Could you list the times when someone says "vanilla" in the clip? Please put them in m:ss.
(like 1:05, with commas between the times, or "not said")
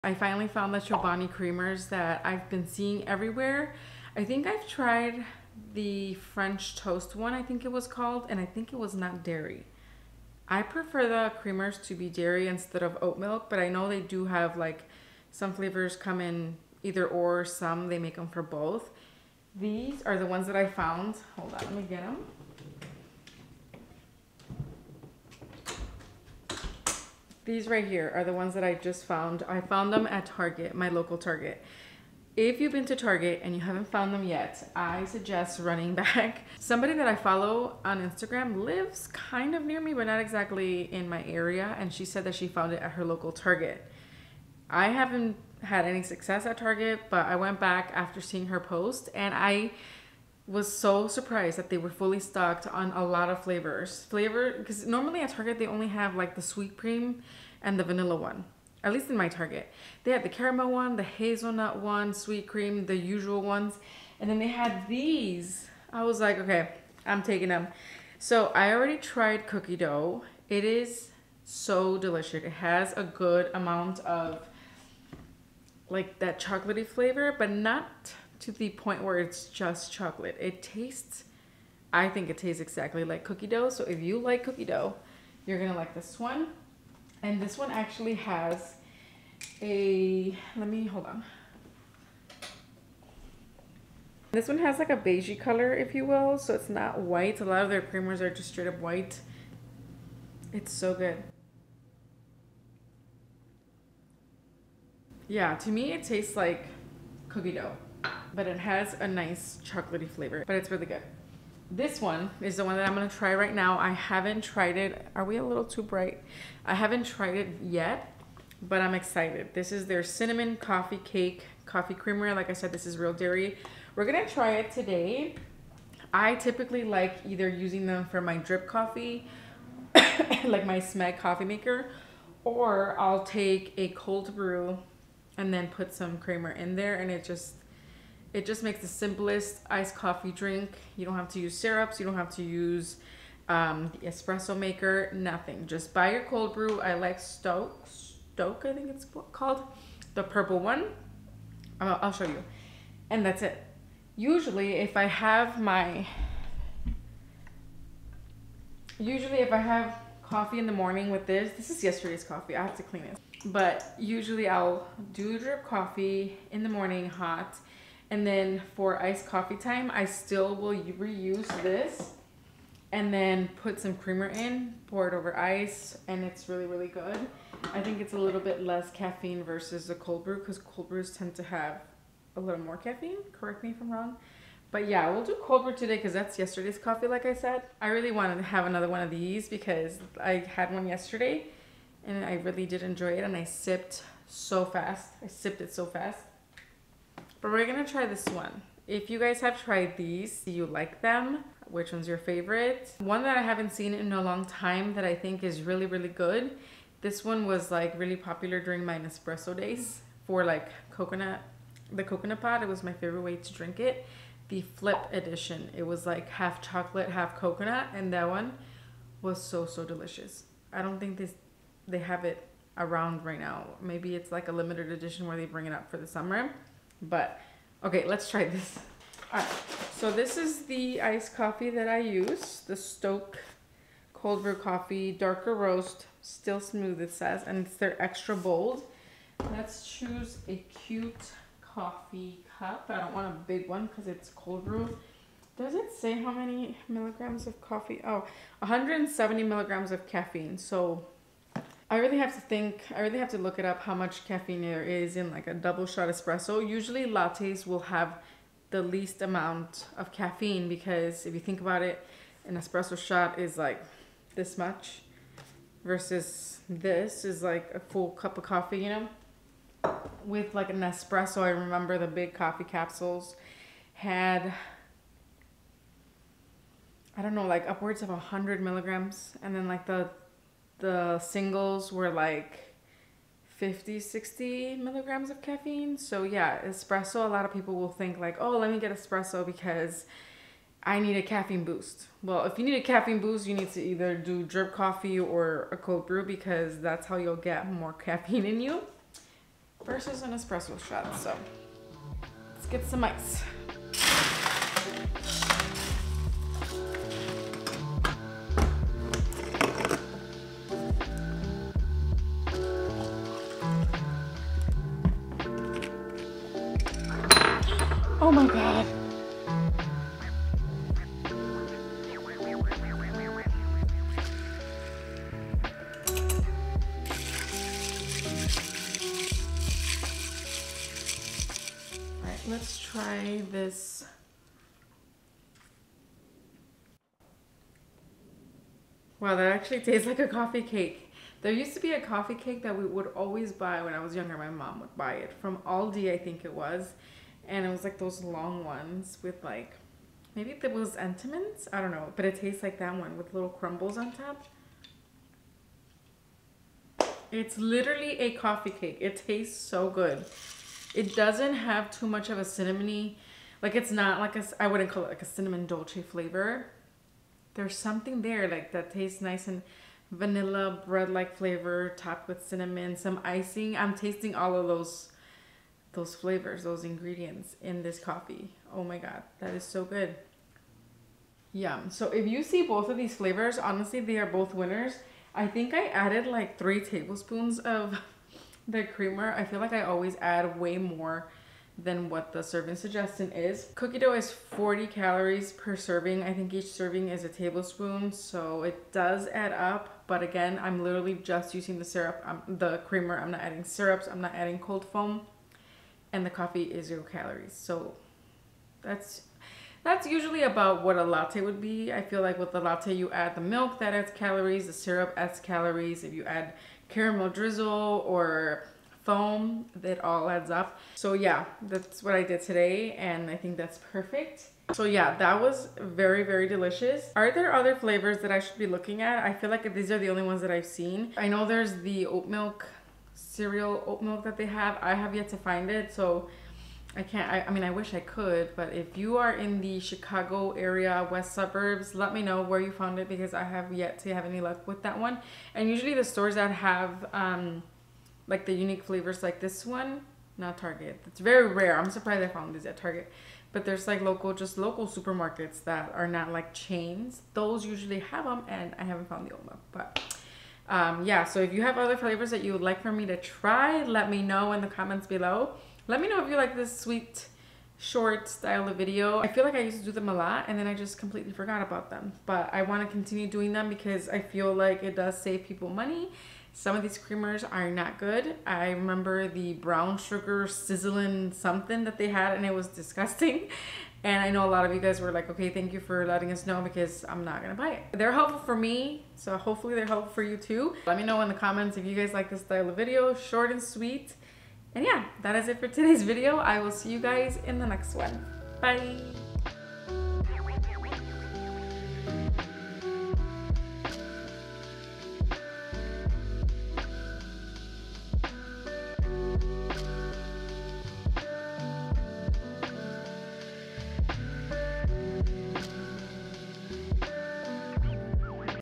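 0:57, 6:10.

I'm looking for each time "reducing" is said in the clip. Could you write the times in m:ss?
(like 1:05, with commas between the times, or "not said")
not said.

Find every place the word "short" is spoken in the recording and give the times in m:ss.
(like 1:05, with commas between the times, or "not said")
7:47, 8:13.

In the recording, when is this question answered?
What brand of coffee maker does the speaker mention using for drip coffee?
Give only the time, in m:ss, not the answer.
2:10.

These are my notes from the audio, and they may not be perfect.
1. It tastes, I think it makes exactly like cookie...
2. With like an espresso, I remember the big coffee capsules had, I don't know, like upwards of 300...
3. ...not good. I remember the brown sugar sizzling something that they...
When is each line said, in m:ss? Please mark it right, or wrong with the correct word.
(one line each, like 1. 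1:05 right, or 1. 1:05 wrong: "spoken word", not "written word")
1. 1:20 wrong: "tastes", not "makes"
2. 4:30 wrong: "100", not "300"
3. 7:57 right.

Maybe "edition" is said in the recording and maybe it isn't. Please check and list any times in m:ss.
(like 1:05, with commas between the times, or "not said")
3:35, 3:44.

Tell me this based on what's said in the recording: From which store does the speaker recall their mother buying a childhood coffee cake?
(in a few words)
Aldi.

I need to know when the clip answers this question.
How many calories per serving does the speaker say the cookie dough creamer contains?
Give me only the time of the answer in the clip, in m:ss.
6:34.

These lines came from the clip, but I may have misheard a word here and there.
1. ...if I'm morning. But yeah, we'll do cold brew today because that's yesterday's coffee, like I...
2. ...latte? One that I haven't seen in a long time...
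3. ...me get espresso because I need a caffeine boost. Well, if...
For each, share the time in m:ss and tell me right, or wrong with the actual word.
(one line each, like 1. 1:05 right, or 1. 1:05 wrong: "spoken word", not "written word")
1. 3:03 wrong: "wrong", not "morning"
2. 3:22 wrong: "favorite", not "latte"
3. 4:48 right.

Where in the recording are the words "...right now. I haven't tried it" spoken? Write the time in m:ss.
1:53.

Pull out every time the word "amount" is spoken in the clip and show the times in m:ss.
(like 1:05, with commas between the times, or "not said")
1:13, 4:19.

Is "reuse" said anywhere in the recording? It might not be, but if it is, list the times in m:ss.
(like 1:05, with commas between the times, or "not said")
2:50.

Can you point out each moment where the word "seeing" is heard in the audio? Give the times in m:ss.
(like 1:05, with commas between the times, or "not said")
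0:02, 0:48.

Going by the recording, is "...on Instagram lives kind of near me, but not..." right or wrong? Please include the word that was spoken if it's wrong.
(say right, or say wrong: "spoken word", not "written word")
right.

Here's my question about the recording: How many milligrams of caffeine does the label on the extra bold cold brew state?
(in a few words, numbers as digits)
170.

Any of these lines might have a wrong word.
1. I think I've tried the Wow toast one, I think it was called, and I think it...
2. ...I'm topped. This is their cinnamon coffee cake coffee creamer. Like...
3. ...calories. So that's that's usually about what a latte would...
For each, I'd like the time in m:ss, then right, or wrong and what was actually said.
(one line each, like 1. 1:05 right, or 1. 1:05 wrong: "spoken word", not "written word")
1. 0:04 wrong: "French", not "Wow"
2. 1:58 wrong: "excited", not "topped"
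3. 6:47 right.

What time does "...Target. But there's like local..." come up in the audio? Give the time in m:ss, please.
7:32.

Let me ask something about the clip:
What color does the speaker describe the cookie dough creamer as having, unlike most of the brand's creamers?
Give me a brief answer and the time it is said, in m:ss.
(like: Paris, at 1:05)
beigey, at 1:34.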